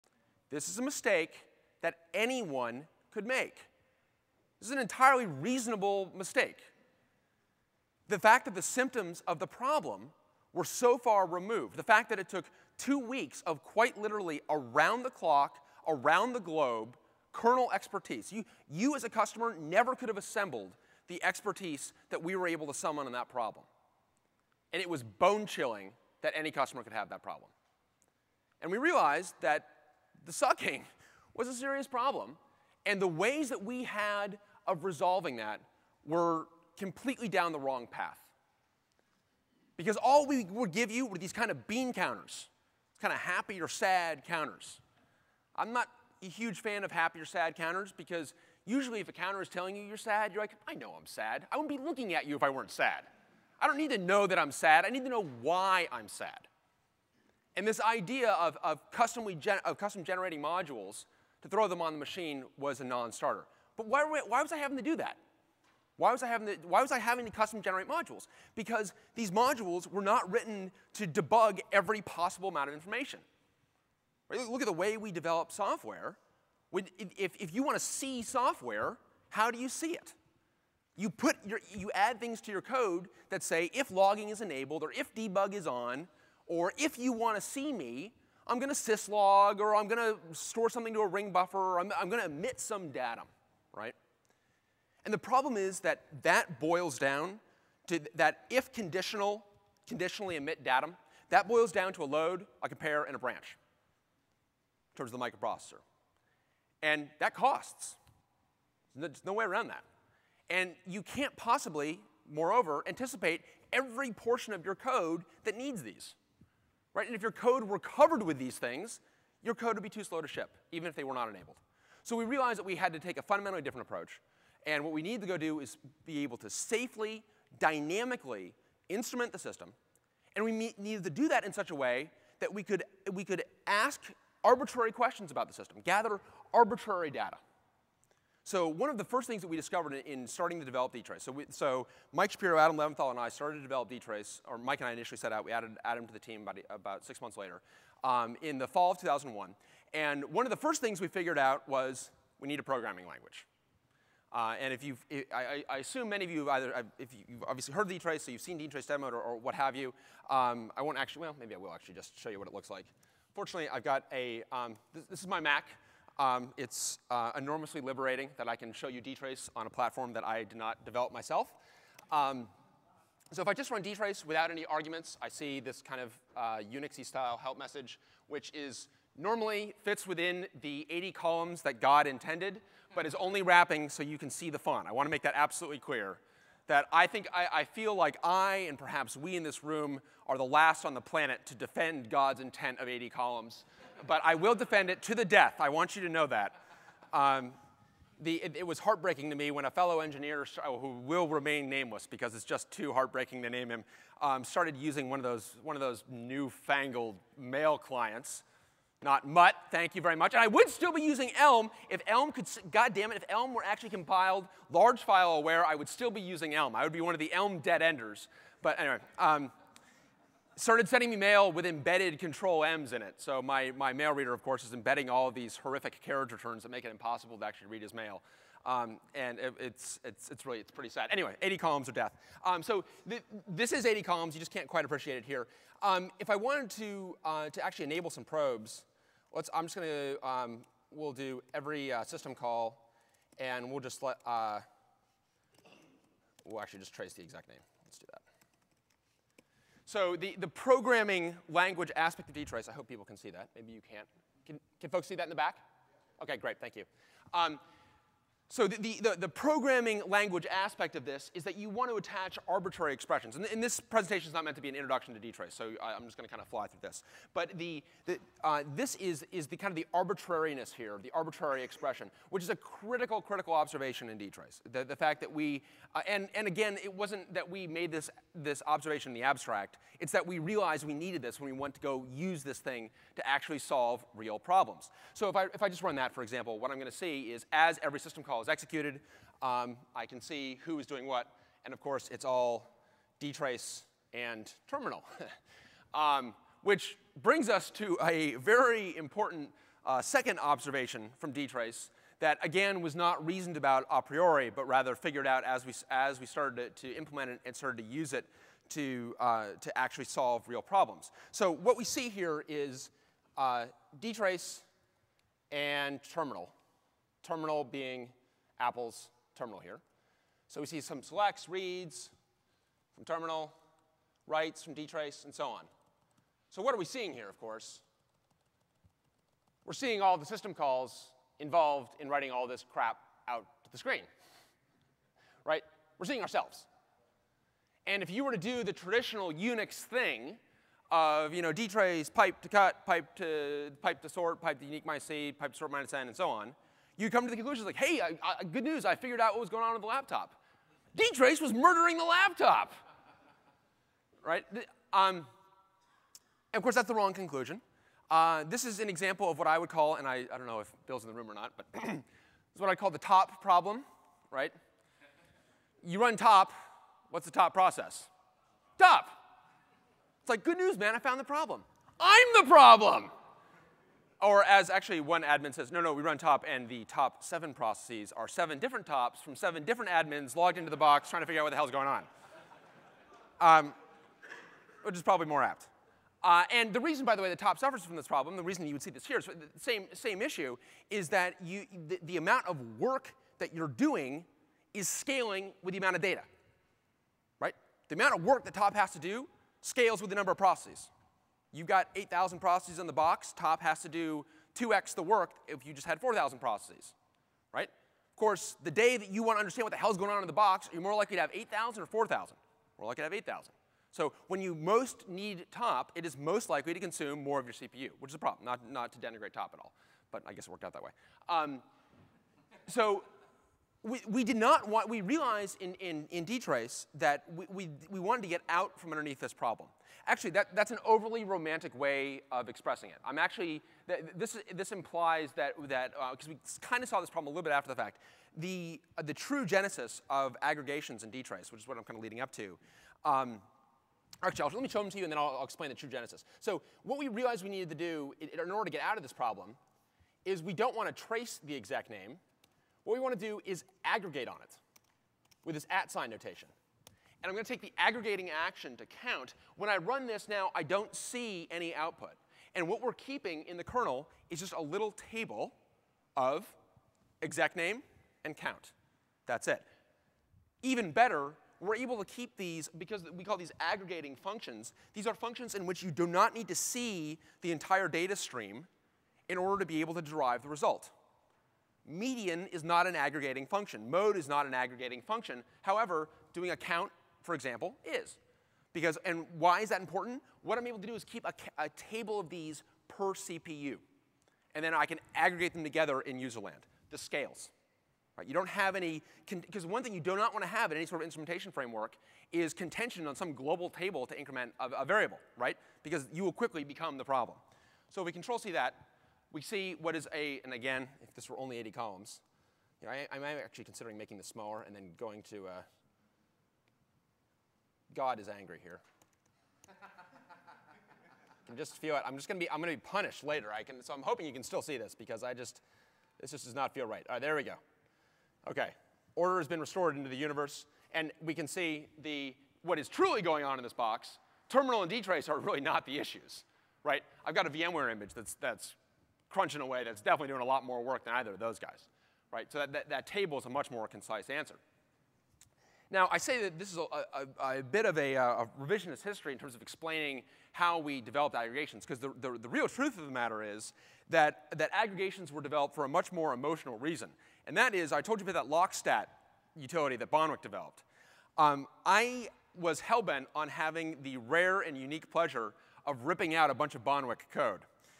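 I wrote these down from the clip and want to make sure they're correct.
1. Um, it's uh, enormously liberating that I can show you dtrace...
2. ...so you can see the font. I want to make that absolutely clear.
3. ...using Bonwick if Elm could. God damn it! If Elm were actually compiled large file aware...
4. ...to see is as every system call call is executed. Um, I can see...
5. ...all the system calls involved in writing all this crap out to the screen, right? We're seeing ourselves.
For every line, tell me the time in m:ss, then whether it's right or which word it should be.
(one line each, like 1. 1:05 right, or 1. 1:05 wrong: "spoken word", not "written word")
1. 2:46 right
2. 3:03 right
3. 3:31 wrong: "Elm", not "Bonwick"
4. 4:46 right
5. 5:30 right.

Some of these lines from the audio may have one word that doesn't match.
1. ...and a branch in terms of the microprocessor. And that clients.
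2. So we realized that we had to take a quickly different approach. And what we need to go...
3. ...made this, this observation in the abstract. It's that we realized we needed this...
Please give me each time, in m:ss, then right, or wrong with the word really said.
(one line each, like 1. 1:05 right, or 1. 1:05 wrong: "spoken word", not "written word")
1. 1:43 wrong: "costs", not "clients"
2. 2:02 wrong: "fundamentally", not "quickly"
3. 4:37 right.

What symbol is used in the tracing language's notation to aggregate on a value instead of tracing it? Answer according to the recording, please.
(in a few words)
at sign.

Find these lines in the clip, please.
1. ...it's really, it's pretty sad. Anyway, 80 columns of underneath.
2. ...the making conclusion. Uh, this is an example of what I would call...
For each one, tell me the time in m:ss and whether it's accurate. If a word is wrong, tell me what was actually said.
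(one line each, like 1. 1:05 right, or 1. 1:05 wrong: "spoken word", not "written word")
1. 3:50 wrong: "death", not "underneath"
2. 5:56 wrong: "wrong", not "making".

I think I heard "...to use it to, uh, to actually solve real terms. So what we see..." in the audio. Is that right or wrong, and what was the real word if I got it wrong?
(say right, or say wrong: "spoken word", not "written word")
wrong: "problems", not "terms".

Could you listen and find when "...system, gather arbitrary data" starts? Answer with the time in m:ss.
2:15.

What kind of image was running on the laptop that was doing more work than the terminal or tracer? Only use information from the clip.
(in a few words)
VMware image.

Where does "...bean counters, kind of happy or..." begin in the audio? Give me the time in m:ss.
0:41.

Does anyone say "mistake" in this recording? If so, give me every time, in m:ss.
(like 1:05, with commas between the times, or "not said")
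0:00, 0:06.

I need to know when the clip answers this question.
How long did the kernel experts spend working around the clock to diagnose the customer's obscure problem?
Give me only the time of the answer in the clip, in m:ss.
0:12.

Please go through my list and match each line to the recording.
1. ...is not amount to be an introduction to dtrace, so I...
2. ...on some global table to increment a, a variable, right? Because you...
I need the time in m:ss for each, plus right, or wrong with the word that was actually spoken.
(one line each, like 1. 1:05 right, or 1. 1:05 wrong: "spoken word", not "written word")
1. 4:24 wrong: "meant", not "amount"
2. 8:23 right.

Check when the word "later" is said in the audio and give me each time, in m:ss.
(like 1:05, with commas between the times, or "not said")
2:27, 8:43.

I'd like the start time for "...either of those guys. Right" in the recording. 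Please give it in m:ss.
9:01.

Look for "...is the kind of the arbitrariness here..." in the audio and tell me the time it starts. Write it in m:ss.
4:29.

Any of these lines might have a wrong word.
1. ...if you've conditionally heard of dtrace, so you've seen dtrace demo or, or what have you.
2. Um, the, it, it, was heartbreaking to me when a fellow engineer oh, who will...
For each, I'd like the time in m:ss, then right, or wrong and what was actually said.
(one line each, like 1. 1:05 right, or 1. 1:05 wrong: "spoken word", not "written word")
1. 2:36 wrong: "obviously", not "conditionally"
2. 3:17 right.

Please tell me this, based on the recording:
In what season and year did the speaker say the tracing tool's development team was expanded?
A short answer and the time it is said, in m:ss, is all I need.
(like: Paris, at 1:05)
fall of 2001, at 2:28.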